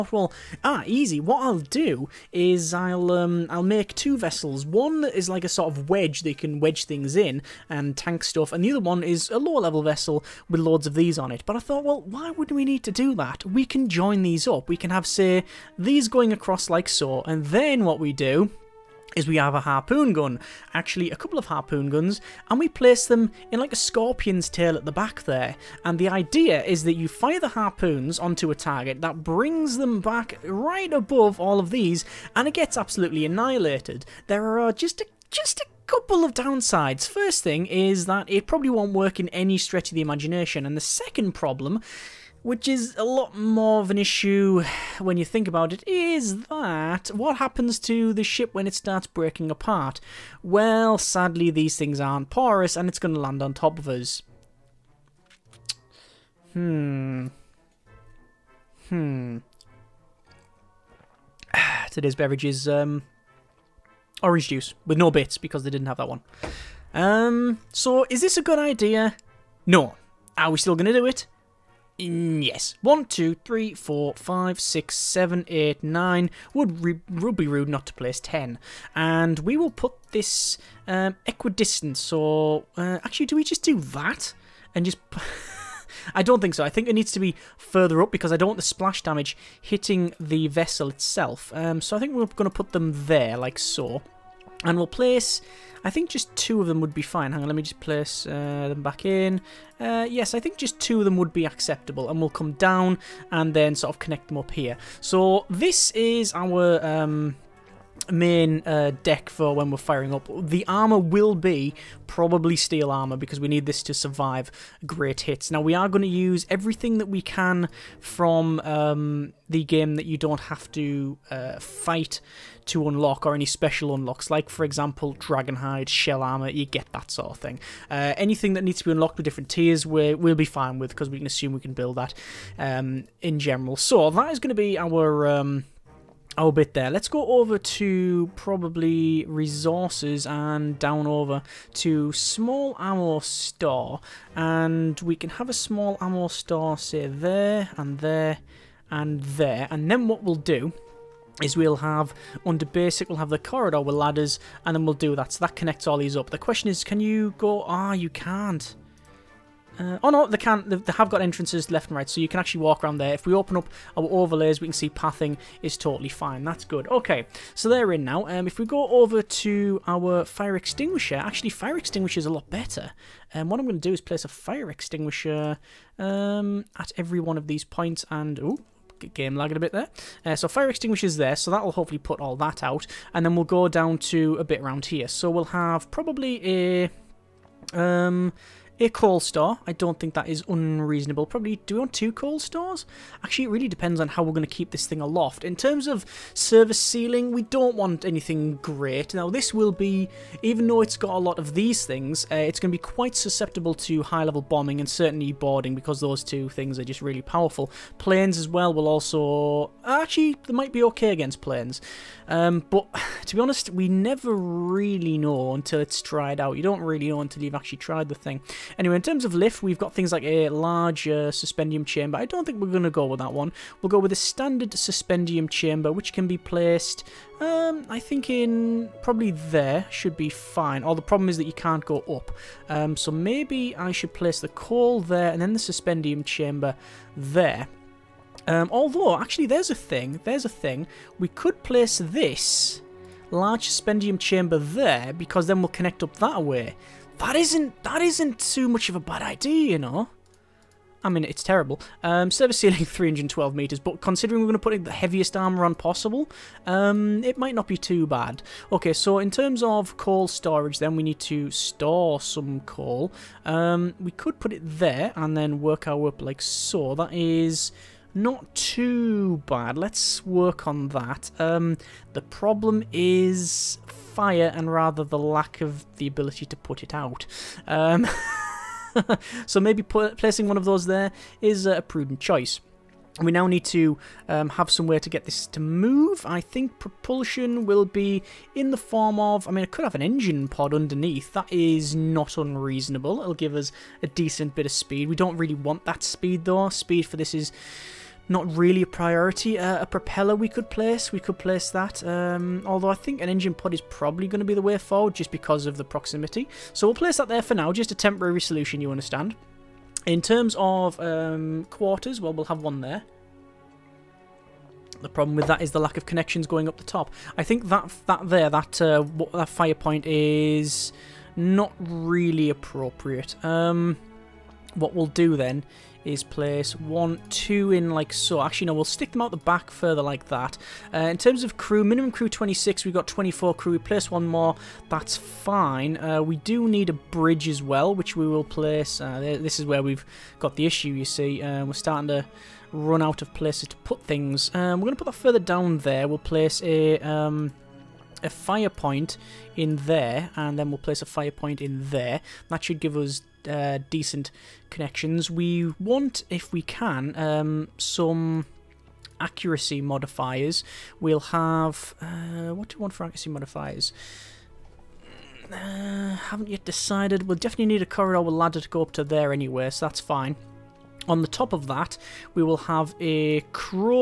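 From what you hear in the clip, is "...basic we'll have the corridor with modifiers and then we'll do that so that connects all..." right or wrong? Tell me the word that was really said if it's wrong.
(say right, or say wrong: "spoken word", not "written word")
wrong: "ladders", not "modifiers".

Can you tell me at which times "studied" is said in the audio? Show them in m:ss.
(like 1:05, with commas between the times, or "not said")
not said.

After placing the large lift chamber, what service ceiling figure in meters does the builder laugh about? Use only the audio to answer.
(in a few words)
312.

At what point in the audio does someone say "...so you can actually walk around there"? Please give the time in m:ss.
2:42.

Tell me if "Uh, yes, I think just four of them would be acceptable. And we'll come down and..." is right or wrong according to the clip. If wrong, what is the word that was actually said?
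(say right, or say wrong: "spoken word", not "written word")
wrong: "two", not "four".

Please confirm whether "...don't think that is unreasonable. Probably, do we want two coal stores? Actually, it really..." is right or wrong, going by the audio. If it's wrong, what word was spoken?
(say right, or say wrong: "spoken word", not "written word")
right.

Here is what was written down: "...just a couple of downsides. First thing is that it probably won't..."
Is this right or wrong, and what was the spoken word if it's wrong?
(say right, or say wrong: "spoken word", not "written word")
right.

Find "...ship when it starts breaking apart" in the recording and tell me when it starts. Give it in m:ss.
0:48.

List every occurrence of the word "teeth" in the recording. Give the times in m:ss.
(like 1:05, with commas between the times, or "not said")
not said.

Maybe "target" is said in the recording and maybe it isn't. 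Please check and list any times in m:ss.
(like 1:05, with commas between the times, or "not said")
0:28.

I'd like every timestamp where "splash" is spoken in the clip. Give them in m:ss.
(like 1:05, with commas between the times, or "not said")
1:28.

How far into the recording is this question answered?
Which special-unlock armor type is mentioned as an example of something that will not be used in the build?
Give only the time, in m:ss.
2:05.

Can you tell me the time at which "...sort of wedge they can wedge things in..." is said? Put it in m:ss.
0:05.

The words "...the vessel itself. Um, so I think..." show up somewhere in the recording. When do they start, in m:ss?
1:30.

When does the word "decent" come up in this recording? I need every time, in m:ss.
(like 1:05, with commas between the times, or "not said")
4:54, 5:53.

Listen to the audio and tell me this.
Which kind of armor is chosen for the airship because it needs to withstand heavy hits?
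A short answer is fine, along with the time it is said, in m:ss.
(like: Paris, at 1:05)
steel armor, at 1:52.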